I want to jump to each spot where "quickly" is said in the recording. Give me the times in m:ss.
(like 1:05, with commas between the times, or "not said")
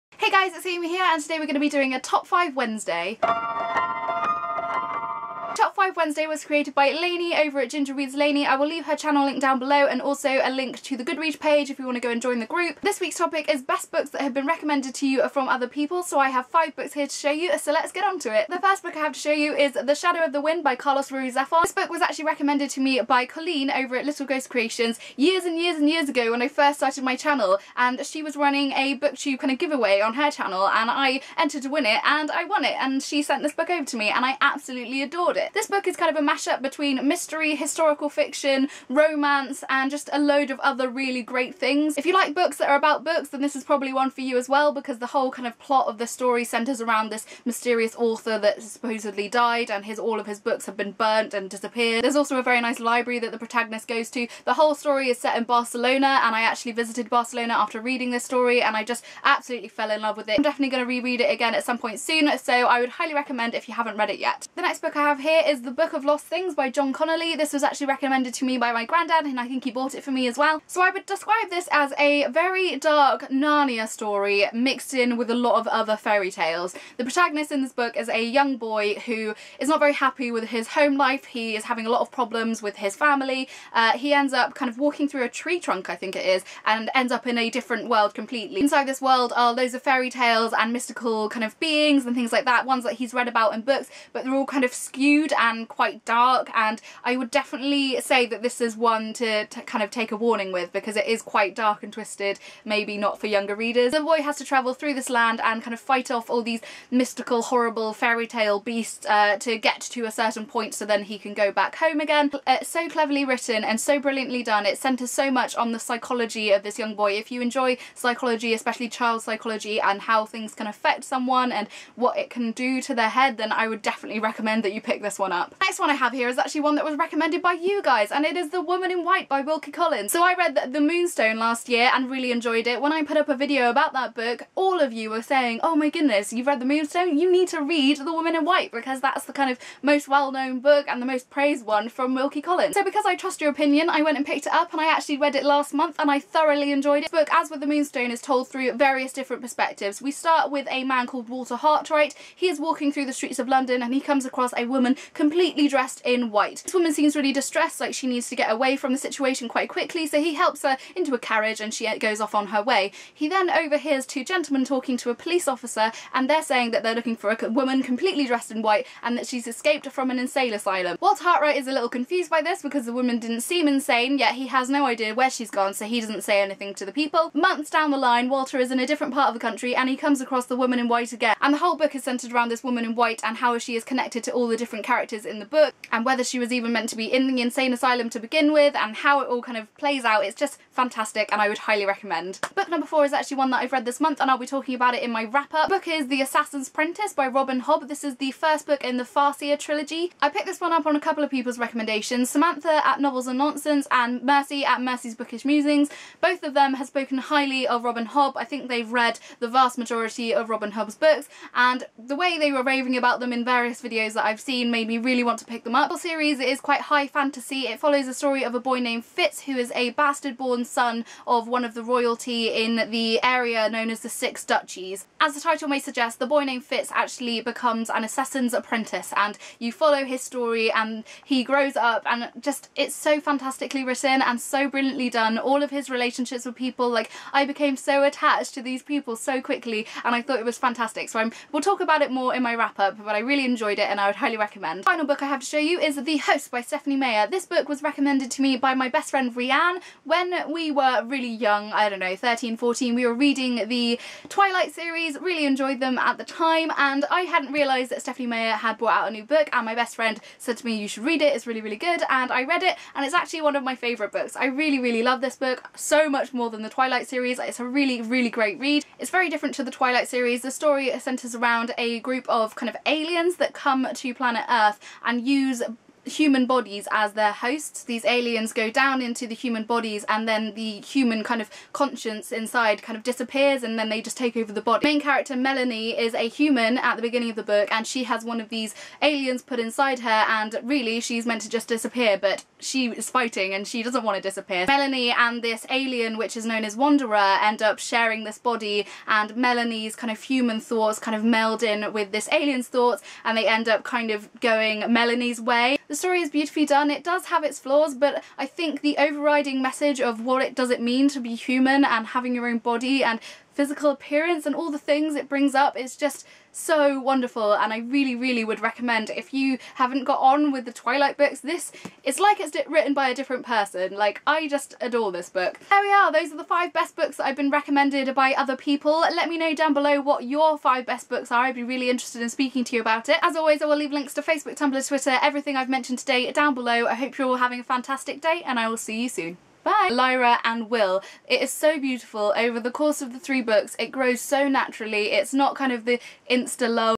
2:39, 3:59.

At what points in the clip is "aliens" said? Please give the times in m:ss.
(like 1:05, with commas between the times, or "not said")
4:32, 4:38, 4:49, 4:55, 5:02.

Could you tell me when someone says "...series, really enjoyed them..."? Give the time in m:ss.
4:14.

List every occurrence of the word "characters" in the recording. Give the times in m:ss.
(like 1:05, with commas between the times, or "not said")
3:04, 4:45.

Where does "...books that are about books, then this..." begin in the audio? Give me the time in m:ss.
0:42.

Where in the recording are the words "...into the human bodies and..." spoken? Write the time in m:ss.
4:39.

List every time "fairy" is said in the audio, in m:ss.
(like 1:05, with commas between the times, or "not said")
1:15, 1:29, 1:47.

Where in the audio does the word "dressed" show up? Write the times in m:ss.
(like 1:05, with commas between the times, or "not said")
2:35, 2:48.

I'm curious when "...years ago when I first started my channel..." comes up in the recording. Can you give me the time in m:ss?
0:25.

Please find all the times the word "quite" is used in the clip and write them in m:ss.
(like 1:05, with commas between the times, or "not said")
1:35, 1:41, 2:39, 3:36.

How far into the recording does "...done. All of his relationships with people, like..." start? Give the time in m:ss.
3:55.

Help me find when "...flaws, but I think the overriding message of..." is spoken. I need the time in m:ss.
5:07.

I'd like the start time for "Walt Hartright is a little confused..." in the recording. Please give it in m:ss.
2:50.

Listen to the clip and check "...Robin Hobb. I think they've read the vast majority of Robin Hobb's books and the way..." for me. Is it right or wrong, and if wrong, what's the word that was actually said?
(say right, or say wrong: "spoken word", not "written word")
right.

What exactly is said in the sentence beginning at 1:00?
I'm definitely going to reread it again at some point soon so I would highly recommend if you haven't read it yet.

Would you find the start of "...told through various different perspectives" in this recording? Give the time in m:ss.
2:28.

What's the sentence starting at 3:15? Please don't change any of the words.
The book is The Assassin's Apprentice by Robin Hobb.